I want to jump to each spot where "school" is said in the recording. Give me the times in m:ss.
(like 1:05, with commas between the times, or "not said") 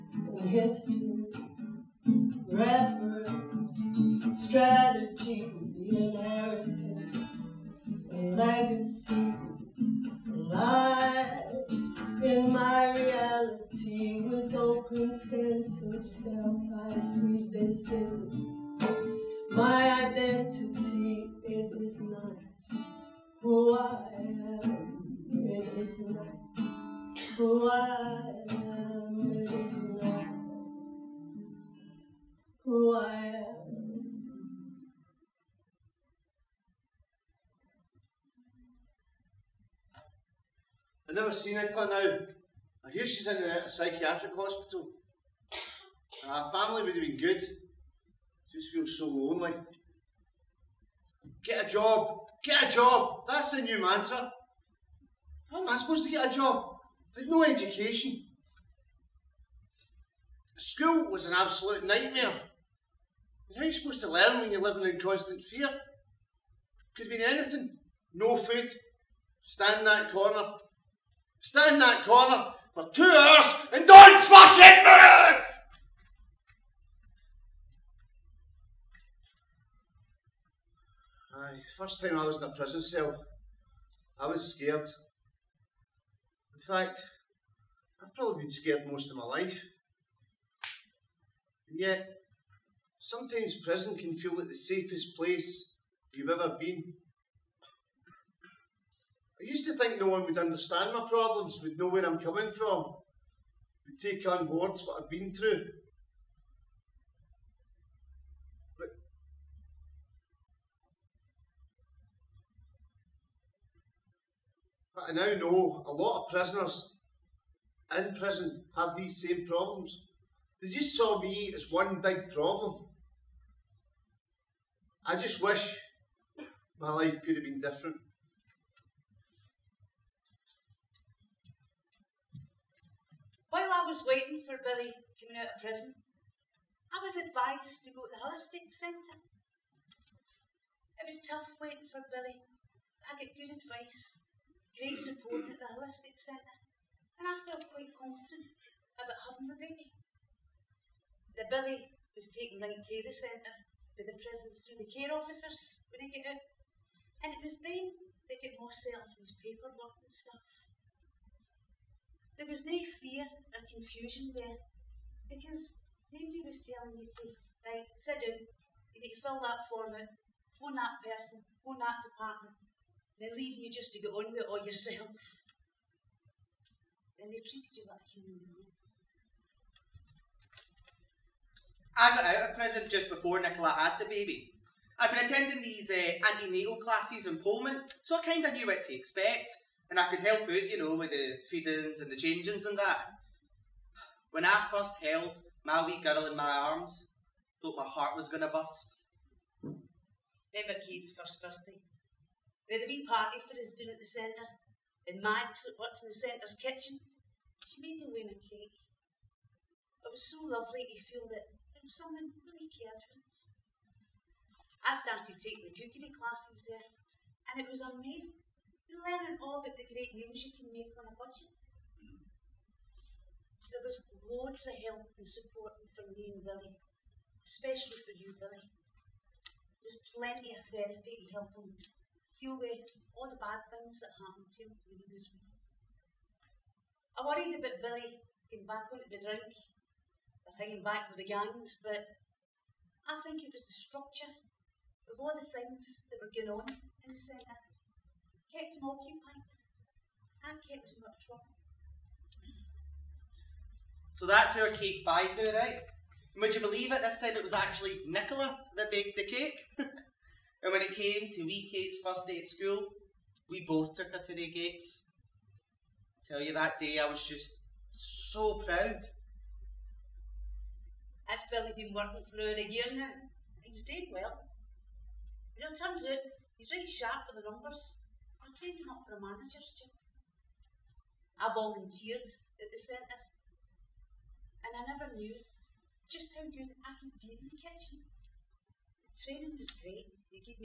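1:00, 4:22.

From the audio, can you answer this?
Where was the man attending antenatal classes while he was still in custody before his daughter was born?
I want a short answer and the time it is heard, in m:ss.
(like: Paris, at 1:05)
Polmont, at 3:07.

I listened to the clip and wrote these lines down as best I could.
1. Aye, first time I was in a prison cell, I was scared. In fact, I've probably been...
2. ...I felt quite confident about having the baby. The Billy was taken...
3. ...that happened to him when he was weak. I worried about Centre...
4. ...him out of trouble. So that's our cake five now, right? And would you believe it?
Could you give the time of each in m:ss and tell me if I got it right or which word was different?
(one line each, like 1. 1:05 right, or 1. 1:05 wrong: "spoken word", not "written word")
1. 1:21 right
2. 2:27 right
3. 3:54 wrong: "Billy", not "Centre"
4. 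4:10 right.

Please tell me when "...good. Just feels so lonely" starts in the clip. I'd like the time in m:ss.
0:47.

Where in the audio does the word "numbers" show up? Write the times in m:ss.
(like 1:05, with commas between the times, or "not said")
4:37.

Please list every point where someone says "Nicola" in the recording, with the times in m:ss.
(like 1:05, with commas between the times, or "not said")
3:03, 4:18.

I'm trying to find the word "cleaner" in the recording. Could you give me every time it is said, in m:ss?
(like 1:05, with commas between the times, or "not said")
not said.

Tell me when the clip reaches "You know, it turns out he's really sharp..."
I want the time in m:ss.
4:35.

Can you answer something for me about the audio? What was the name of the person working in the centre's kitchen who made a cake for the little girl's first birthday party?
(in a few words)
Max.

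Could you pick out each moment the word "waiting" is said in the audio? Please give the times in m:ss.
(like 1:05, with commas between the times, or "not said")
2:14, 2:21.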